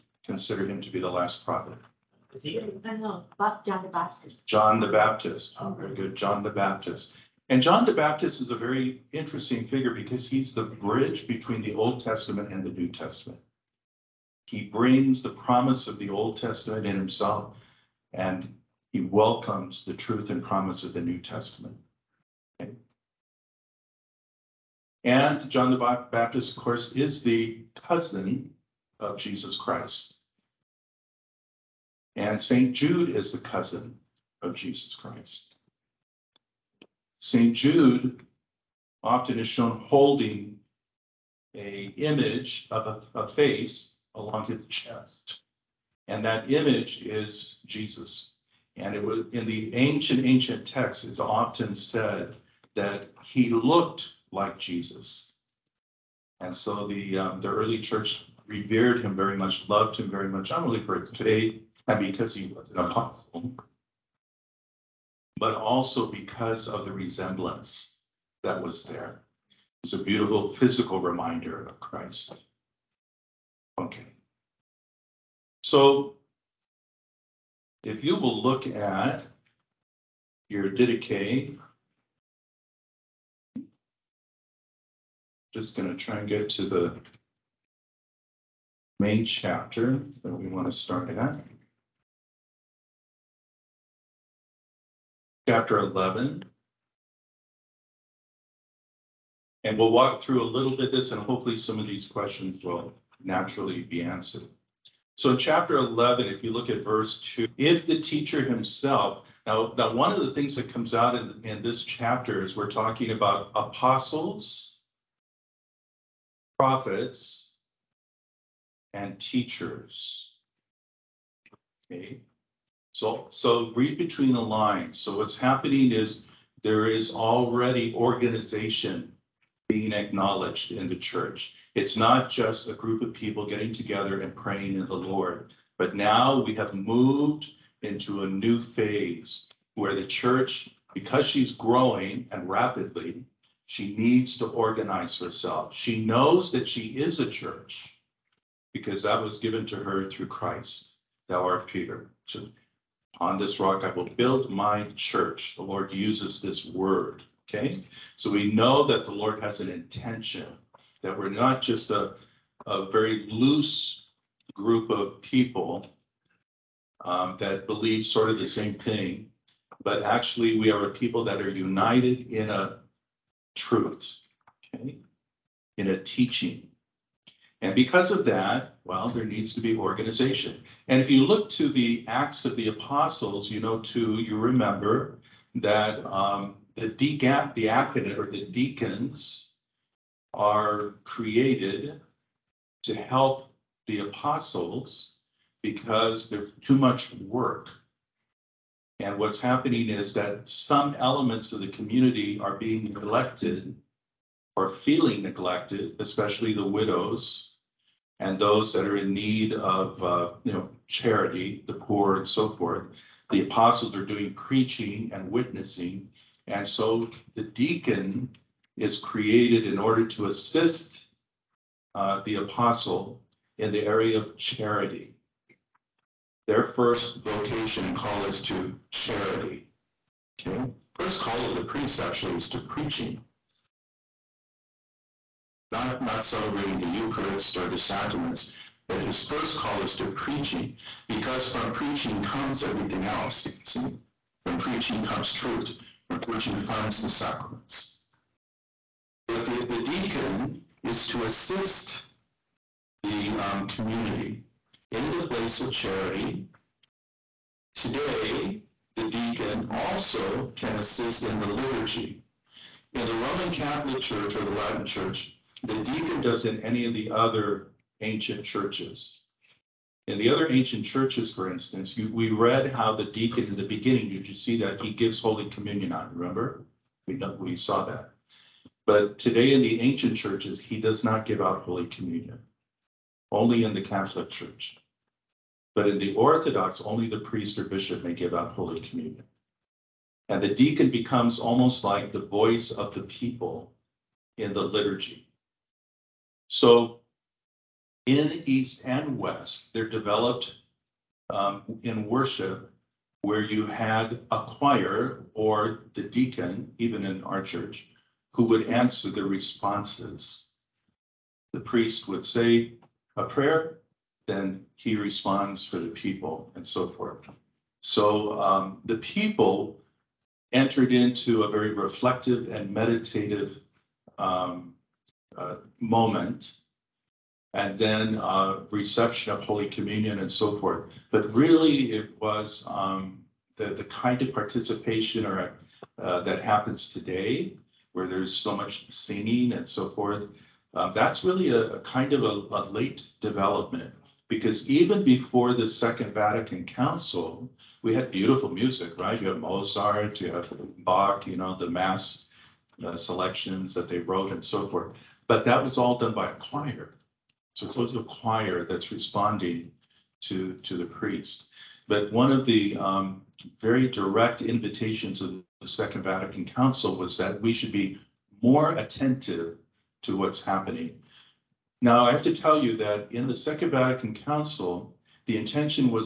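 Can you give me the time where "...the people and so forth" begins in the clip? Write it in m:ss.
5:15.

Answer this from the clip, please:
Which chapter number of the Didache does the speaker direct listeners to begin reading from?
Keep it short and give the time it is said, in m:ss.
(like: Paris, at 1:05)
11, at 1:35.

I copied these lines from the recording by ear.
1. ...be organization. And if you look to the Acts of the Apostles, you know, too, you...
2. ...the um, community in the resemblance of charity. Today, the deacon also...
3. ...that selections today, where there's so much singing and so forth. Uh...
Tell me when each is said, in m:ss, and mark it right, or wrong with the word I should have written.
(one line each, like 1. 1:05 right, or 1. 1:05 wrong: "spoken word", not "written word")
1. 2:59 right
2. 4:13 wrong: "place", not "resemblance"
3. 5:36 wrong: "happens", not "selections".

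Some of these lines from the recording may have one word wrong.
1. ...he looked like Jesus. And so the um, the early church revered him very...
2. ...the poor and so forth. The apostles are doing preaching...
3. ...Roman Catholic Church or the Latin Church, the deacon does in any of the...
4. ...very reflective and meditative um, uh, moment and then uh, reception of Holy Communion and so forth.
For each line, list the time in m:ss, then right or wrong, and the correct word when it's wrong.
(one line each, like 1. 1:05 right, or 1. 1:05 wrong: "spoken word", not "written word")
1. 0:53 right
2. 3:31 right
3. 4:23 right
4. 5:21 right.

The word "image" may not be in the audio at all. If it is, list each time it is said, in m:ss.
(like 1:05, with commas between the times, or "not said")
0:41, 0:46.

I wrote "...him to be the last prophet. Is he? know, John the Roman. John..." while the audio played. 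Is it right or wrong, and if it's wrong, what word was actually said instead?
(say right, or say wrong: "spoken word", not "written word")
wrong: "Baptist", not "Roman".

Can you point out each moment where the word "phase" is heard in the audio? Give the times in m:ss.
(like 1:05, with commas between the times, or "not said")
2:18.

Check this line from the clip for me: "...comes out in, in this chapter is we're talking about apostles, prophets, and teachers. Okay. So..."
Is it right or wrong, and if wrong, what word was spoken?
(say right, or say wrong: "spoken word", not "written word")
right.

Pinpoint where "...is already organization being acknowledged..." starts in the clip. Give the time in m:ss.
2:06.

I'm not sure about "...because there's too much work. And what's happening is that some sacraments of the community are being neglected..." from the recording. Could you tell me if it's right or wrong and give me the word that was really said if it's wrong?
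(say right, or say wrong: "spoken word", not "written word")
wrong: "elements", not "sacraments".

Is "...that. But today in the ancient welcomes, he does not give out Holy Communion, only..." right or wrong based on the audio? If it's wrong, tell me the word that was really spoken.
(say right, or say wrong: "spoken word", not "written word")
wrong: "churches", not "welcomes".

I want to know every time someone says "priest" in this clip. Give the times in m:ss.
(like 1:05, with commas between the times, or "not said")
3:51, 4:47, 5:11, 6:00.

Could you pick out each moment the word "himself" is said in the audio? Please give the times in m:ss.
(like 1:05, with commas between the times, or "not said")
0:16, 1:48.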